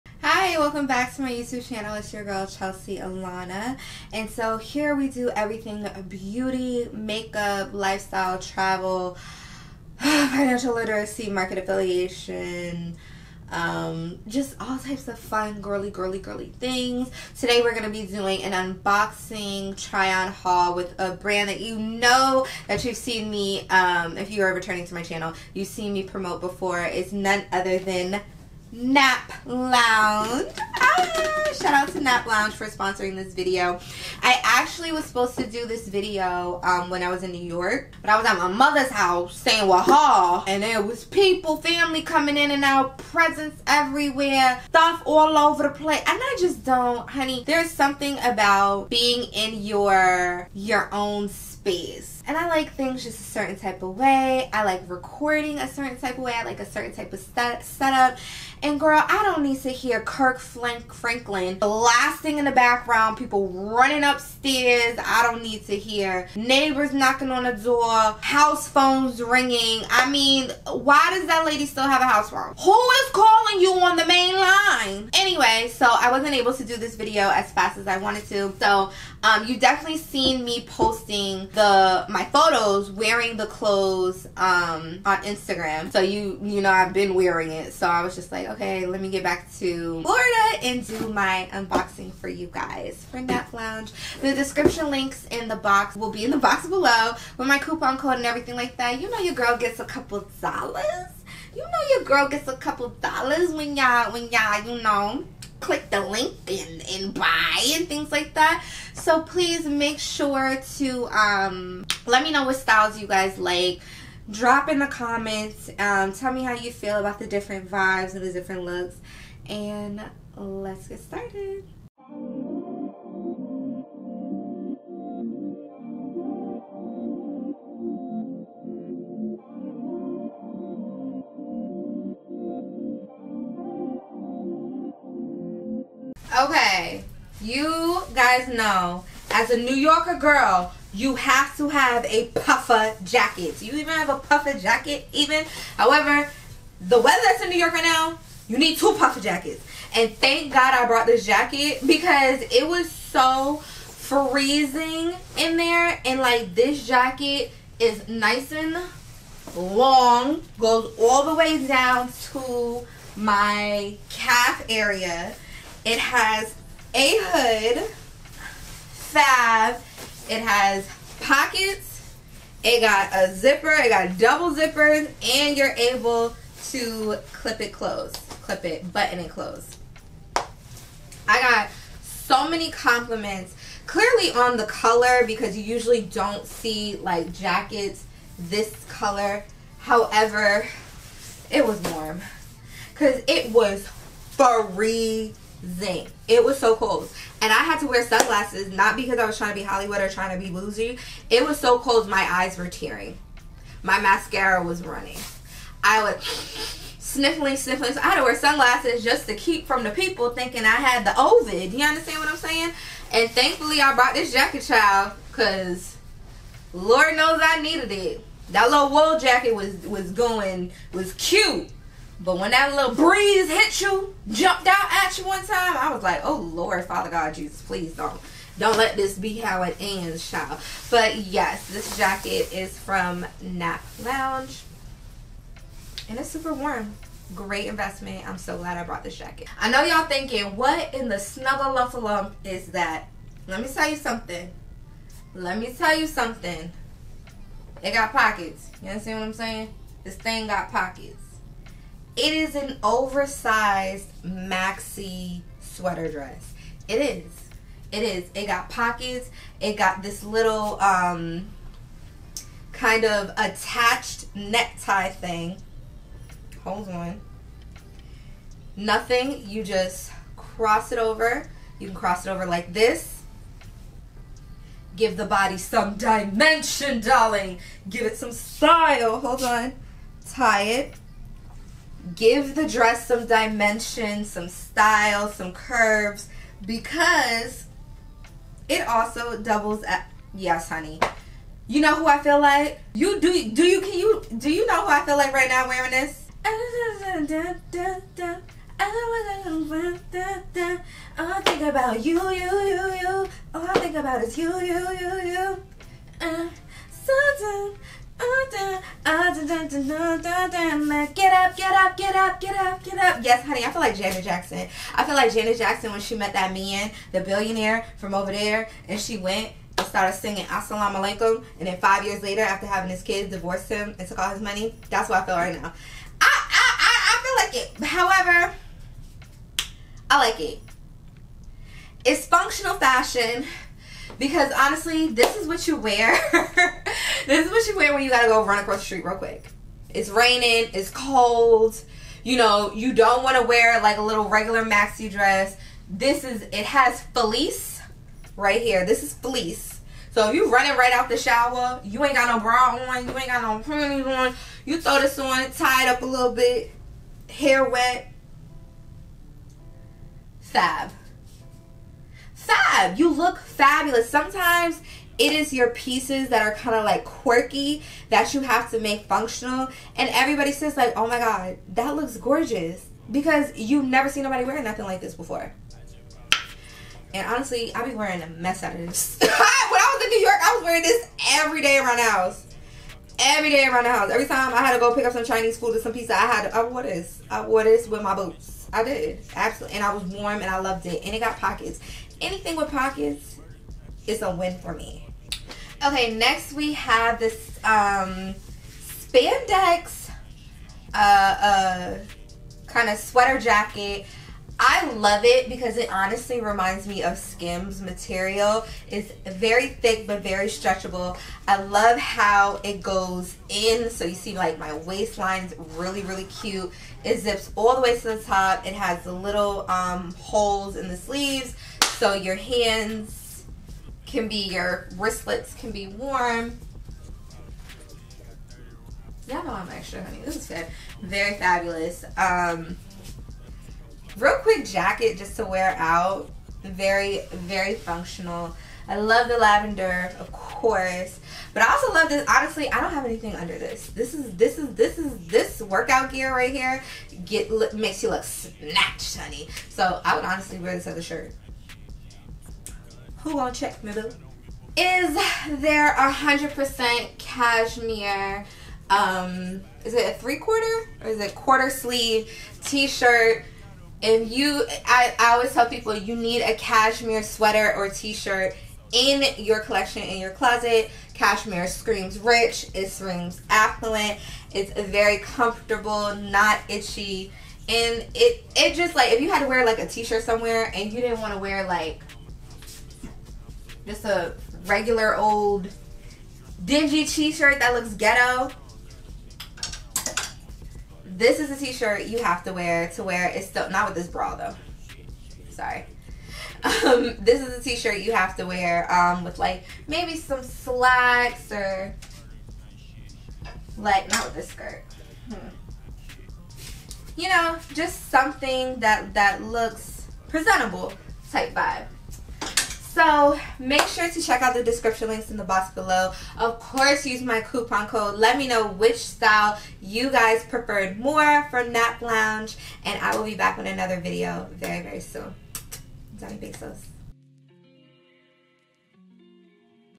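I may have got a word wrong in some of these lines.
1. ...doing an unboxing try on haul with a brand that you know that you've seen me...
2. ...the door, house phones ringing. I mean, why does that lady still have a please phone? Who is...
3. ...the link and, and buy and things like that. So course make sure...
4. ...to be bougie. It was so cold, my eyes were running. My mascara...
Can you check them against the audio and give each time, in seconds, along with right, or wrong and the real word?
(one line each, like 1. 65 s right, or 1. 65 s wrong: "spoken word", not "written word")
1. 18 s right
2. 67 s wrong: "house", not "please"
3. 105 s wrong: "please", not "course"
4. 200 s wrong: "tearing", not "running".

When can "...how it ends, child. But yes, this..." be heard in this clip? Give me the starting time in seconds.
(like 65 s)
229 s.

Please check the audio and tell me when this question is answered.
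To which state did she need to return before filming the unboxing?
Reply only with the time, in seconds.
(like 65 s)
90 s.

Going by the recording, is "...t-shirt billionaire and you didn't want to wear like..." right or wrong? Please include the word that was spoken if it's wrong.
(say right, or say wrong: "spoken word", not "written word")
wrong: "somewhere", not "billionaire".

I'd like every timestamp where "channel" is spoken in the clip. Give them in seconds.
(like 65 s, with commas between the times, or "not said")
1 s, 25 s.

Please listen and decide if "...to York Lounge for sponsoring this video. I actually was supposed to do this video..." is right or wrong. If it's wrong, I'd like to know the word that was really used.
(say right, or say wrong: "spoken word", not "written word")
wrong: "Nap", not "York".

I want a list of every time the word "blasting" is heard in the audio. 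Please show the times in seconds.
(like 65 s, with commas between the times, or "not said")
61 s.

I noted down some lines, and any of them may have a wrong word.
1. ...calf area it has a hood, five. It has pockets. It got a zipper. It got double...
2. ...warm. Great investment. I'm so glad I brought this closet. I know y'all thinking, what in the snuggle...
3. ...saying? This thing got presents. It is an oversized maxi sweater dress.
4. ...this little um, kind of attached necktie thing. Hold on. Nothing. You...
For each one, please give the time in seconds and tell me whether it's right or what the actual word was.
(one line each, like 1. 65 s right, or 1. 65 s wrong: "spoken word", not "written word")
1. 164 s right
2. 236 s wrong: "jacket", not "closet"
3. 249 s wrong: "pockets", not "presents"
4. 260 s right.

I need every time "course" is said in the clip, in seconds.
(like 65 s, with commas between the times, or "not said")
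440 s, 516 s.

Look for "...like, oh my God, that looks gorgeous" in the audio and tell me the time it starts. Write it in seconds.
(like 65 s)
370 s.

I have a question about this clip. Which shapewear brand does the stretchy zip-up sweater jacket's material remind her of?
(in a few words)
Skims.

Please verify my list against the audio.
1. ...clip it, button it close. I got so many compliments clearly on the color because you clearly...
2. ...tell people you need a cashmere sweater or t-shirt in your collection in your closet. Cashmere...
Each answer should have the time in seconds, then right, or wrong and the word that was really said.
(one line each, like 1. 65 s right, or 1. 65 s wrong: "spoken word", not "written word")
1. 178 s wrong: "usually", not "clearly"
2. 465 s right.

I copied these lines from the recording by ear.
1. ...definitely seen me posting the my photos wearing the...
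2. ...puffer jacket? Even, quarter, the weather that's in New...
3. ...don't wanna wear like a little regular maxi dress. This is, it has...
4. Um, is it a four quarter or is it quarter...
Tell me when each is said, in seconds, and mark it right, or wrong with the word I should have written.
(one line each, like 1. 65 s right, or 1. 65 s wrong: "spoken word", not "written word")
1. 79 s right
2. 144 s wrong: "however", not "quarter"
3. 342 s right
4. 458 s wrong: "three", not "four".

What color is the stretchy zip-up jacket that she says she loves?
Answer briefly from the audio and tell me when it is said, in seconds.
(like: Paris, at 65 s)
lavender, at 439 s.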